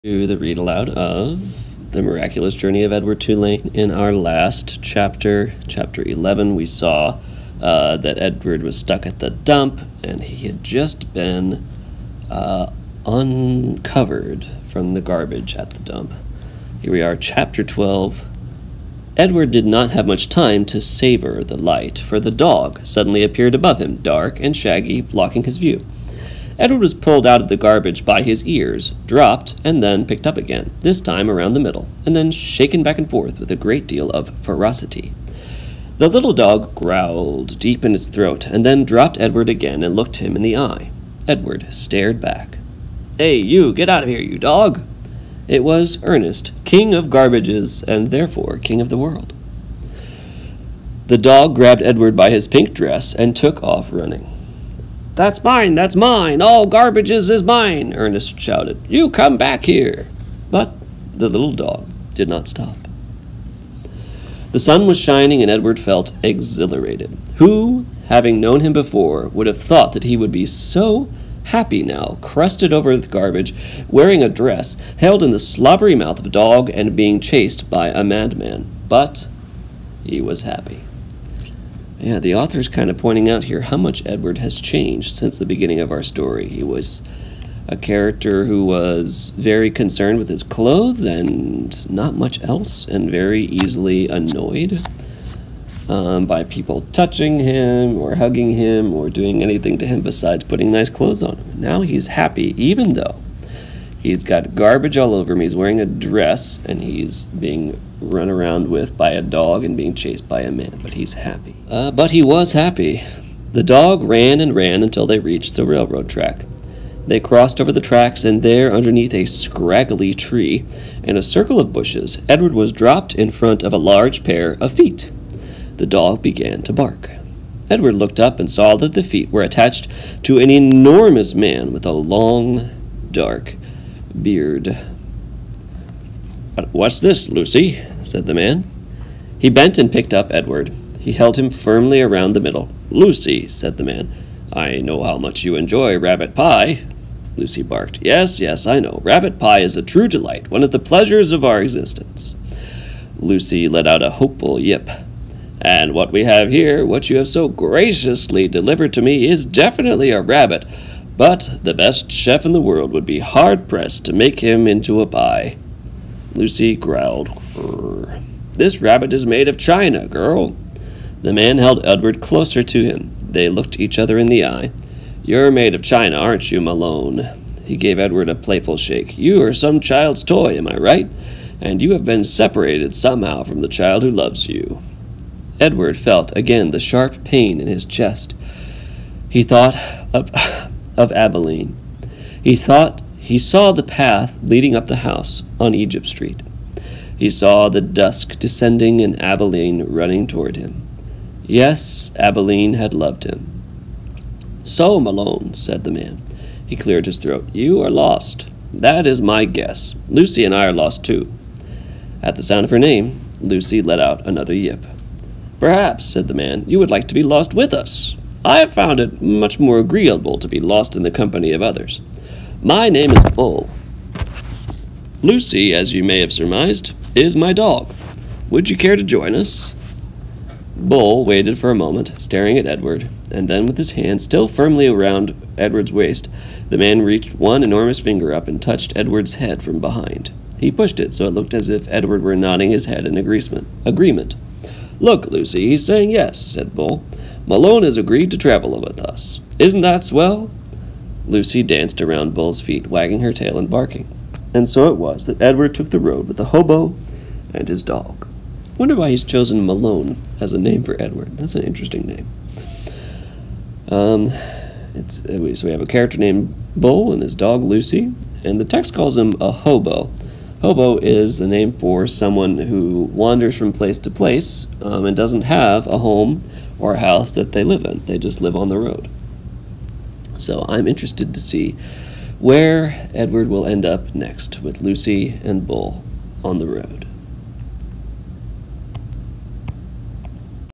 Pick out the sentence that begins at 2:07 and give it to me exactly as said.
Edward looked up and saw that the feet were attached to an enormous man with a long, dark beard.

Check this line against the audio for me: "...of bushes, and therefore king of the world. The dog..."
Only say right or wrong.
wrong.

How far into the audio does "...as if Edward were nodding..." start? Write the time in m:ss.
4:01.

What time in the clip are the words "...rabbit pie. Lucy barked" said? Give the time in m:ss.
2:25.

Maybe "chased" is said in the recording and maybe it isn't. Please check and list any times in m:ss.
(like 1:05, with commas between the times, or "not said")
1:17, 1:49.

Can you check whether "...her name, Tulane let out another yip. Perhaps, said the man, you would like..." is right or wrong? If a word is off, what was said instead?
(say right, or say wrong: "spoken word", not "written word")
wrong: "Lucy", not "Tulane".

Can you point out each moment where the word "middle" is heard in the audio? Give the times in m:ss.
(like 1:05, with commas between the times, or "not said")
0:31, 2:22.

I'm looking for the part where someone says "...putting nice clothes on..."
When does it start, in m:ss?
1:40.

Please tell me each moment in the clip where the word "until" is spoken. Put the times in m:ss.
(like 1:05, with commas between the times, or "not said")
1:54.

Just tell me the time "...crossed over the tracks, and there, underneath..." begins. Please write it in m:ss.
1:57.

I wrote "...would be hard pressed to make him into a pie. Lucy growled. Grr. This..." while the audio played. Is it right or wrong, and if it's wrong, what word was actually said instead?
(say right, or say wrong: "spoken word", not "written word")
right.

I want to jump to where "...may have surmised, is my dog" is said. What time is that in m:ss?
3:46.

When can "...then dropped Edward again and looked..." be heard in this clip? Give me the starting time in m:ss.
0:38.